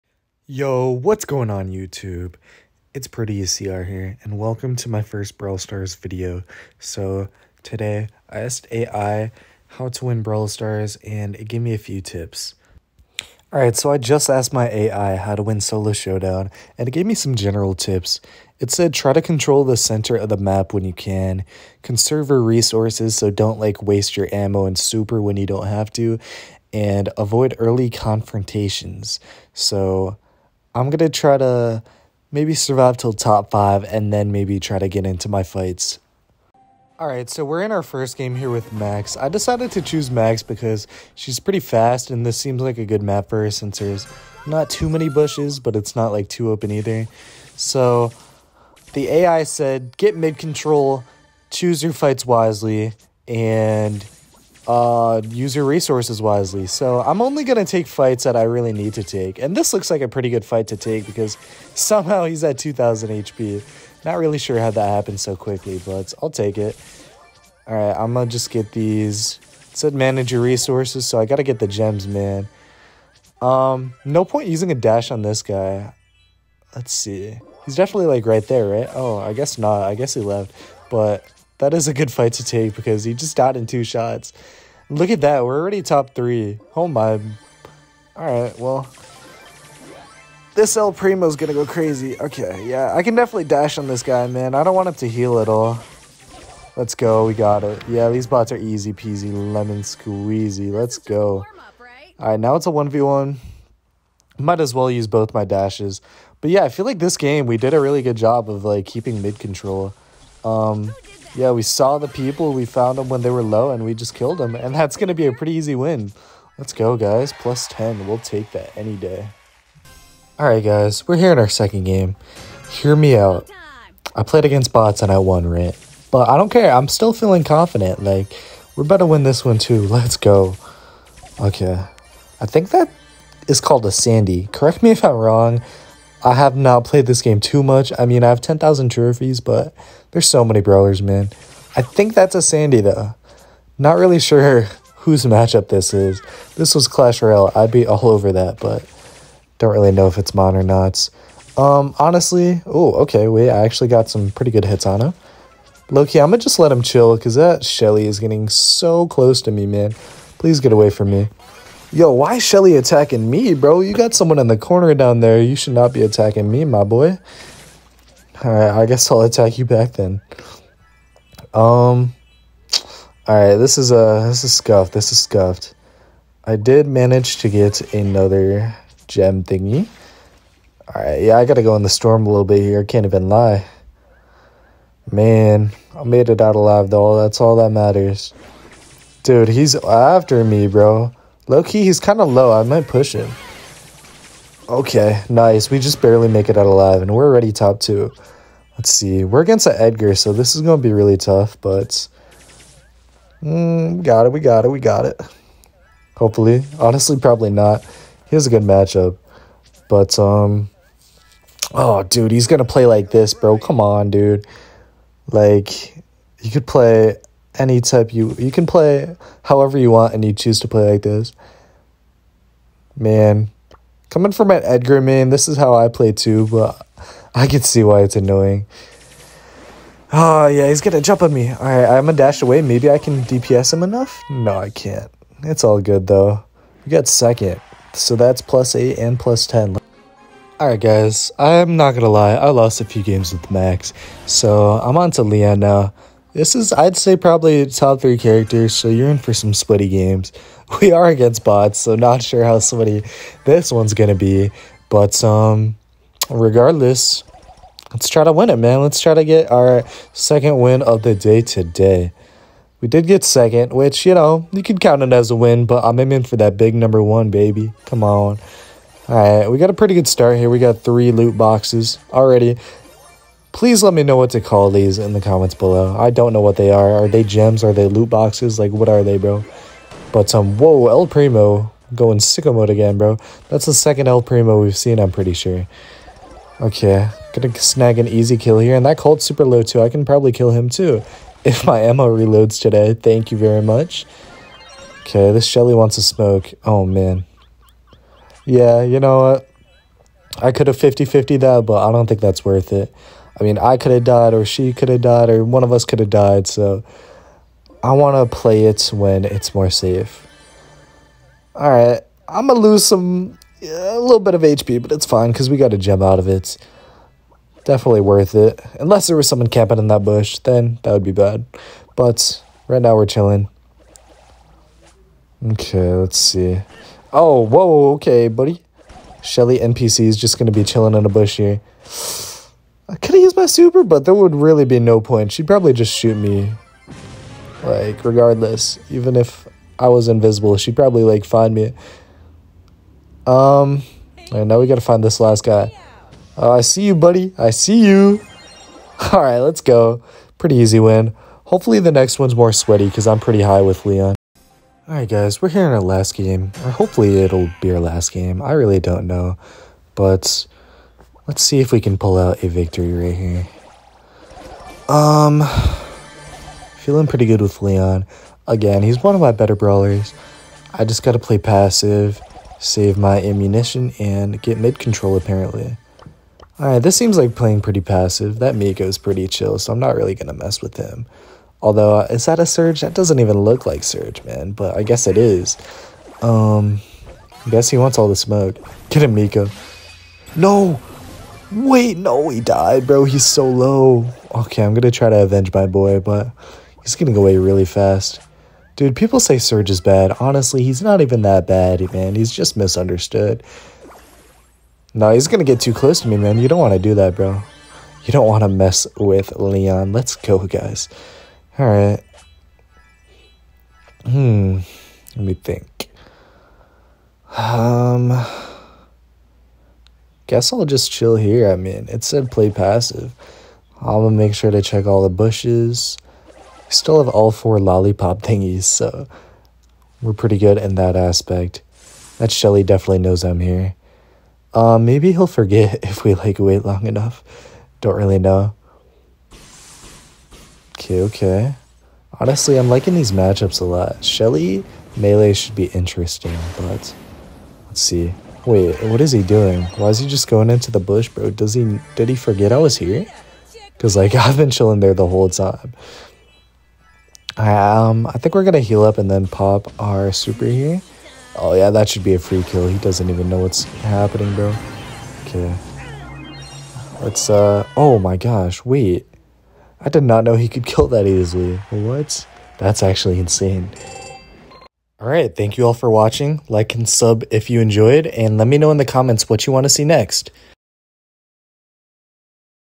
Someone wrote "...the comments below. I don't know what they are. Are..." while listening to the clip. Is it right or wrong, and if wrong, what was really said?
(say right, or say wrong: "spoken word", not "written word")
right.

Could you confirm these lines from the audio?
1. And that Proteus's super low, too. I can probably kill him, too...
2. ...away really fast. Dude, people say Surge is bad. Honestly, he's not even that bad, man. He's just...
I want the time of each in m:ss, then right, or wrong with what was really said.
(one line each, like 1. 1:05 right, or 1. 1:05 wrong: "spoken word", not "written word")
1. 4:48 wrong: "Colt", not "Proteus"
2. 6:37 right.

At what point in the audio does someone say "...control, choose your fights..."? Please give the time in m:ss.
0:50.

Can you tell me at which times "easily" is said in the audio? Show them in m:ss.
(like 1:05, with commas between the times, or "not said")
7:51.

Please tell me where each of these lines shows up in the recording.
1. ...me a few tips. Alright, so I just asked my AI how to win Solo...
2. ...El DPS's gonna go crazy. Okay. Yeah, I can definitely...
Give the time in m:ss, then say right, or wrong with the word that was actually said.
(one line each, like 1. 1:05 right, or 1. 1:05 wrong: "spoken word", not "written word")
1. 0:11 right
2. 1:30 wrong: "Primo", not "DPS".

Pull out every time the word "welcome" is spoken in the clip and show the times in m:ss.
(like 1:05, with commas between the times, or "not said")
0:04.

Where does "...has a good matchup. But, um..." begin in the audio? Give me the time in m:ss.
3:28.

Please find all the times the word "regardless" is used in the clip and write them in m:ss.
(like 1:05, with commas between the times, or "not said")
4:16, 5:38.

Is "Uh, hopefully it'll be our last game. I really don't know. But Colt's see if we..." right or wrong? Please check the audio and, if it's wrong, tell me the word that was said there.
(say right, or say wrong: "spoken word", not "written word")
wrong: "Let", not "Colt".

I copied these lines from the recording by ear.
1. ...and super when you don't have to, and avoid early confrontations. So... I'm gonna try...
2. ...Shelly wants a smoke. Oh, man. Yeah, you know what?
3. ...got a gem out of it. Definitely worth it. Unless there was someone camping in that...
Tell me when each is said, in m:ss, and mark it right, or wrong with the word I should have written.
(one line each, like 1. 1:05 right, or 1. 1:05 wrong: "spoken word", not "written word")
1. 0:24 right
2. 4:55 right
3. 5:15 right.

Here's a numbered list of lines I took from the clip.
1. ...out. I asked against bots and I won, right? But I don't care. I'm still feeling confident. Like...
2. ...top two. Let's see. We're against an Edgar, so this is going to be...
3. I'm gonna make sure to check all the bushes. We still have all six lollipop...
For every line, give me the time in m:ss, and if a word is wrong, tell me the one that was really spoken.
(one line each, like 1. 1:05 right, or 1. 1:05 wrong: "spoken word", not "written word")
1. 2:03 wrong: "played", not "asked"
2. 3:17 right
3. 7:03 wrong: "four", not "six".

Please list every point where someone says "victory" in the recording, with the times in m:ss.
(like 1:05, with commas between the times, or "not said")
6:02.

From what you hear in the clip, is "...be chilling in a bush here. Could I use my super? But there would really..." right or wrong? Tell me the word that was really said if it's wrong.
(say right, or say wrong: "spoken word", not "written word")
right.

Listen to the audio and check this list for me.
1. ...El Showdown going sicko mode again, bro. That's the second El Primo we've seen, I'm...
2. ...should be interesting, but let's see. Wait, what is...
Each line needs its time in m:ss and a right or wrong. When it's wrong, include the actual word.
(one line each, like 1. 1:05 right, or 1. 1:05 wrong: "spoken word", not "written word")
1. 4:40 wrong: "Primo", not "Showdown"
2. 7:25 right.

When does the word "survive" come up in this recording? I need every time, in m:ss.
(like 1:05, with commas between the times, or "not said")
0:32.